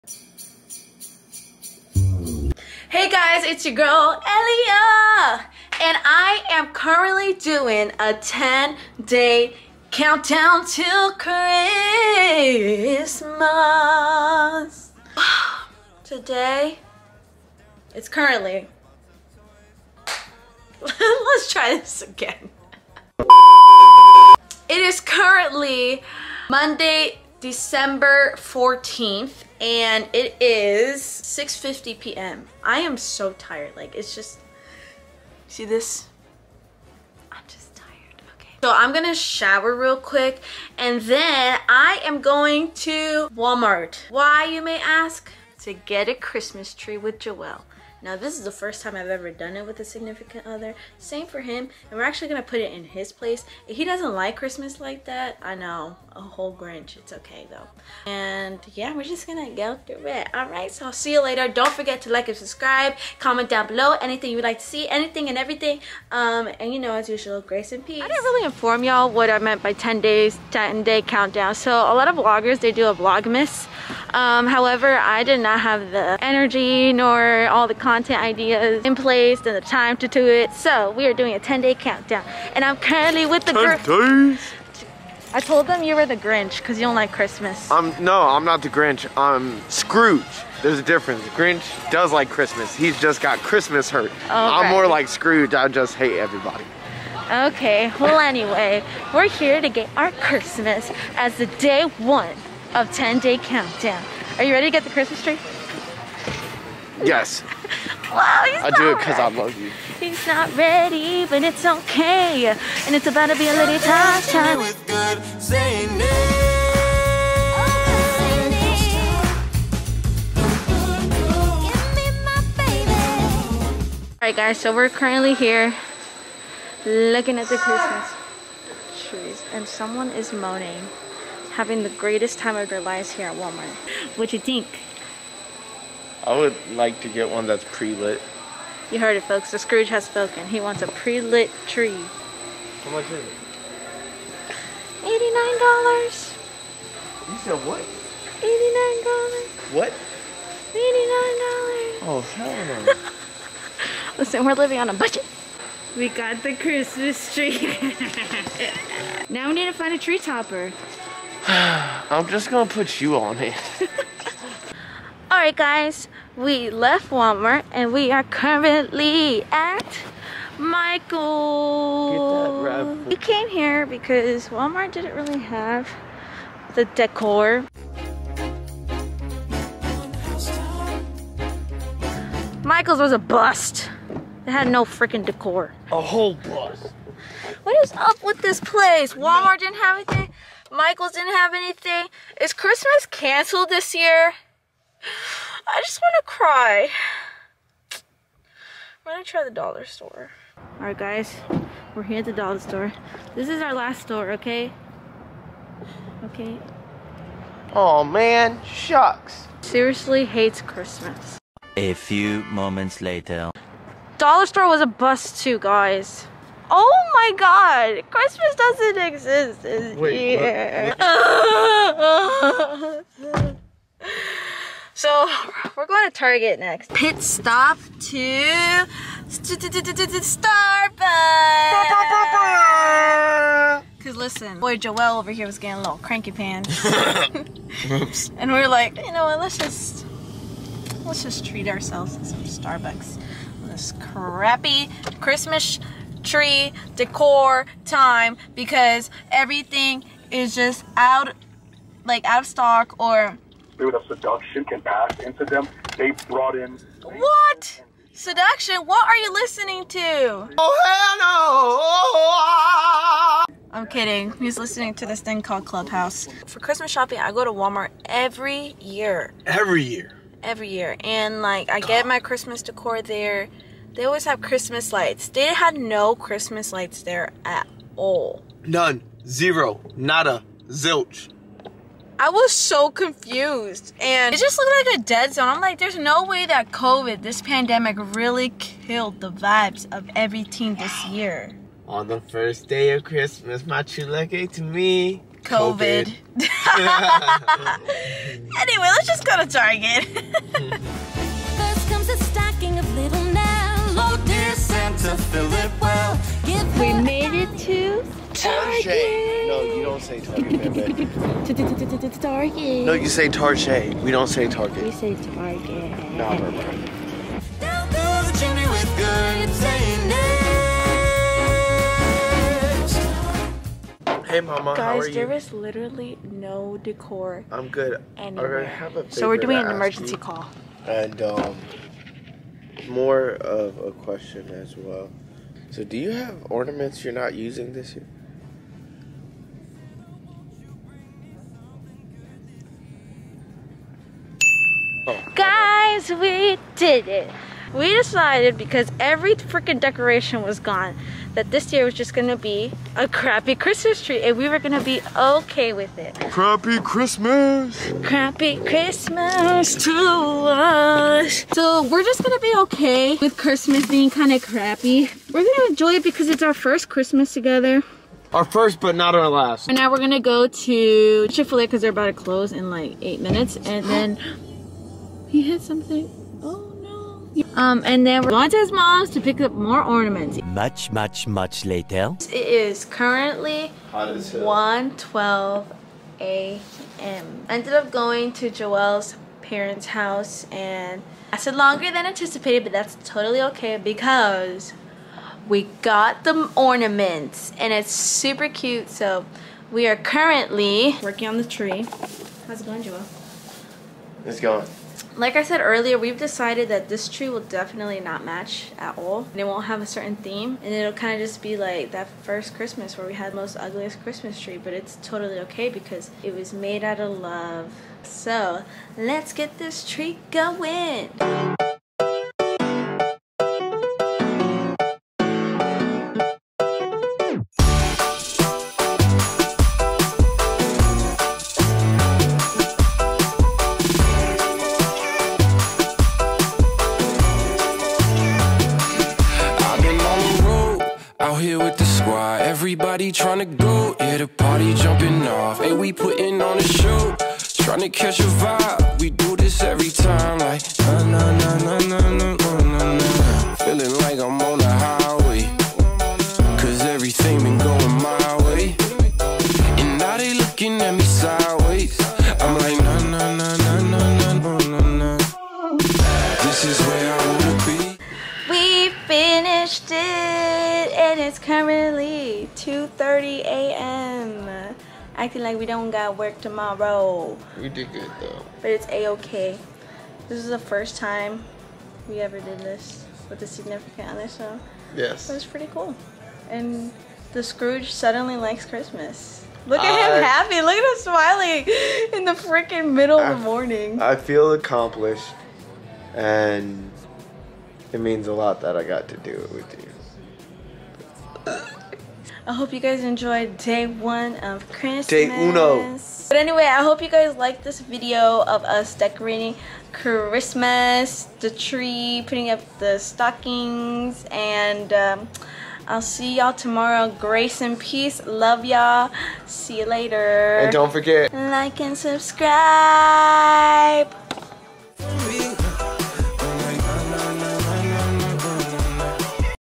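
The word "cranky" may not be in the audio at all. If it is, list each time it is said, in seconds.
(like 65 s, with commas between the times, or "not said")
236 s.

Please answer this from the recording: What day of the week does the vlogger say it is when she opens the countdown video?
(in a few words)
Monday.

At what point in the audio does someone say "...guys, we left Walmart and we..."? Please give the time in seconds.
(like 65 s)
165 s.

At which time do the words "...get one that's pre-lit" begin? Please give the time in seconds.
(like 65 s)
137 s.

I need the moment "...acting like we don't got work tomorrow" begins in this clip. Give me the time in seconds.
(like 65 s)
475 s.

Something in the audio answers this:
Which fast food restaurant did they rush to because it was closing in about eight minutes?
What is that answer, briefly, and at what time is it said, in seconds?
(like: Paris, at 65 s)
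Chick-fil-A, at 371 s.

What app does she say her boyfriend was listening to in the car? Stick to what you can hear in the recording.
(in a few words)
Clubhouse.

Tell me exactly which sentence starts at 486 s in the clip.
And the Scrooge suddenly likes Christmas.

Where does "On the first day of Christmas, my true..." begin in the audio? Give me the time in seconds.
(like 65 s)
291 s.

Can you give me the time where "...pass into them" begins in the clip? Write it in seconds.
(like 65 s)
254 s.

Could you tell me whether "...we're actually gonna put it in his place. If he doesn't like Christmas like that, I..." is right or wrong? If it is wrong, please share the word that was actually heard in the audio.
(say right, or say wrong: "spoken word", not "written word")
right.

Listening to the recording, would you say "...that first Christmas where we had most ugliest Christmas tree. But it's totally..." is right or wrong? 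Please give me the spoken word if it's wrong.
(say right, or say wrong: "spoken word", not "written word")
right.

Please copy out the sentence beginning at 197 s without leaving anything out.
I'm gonna try the dollar store.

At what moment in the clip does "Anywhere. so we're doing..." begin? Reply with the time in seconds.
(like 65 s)
328 s.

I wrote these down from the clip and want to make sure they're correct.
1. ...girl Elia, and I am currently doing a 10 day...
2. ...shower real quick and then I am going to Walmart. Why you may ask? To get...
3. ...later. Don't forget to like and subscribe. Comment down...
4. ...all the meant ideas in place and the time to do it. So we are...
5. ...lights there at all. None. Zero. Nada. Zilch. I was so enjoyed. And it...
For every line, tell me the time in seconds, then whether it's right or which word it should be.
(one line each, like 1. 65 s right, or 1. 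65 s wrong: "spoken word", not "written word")
1. 3 s right
2. 39 s right
3. 61 s right
4. 77 s wrong: "content", not "meant"
5. 276 s wrong: "confused", not "enjoyed".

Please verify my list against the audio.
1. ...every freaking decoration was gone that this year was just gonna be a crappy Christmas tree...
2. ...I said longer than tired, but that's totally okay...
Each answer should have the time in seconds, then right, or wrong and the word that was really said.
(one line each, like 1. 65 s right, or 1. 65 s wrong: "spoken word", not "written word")
1. 348 s right
2. 391 s wrong: "anticipated", not "tired".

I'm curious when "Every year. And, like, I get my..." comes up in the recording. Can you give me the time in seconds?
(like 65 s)
270 s.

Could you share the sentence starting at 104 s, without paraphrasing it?
Are you ready to get the Christmas tree?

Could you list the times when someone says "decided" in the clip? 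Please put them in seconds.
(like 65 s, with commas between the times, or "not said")
347 s, 406 s.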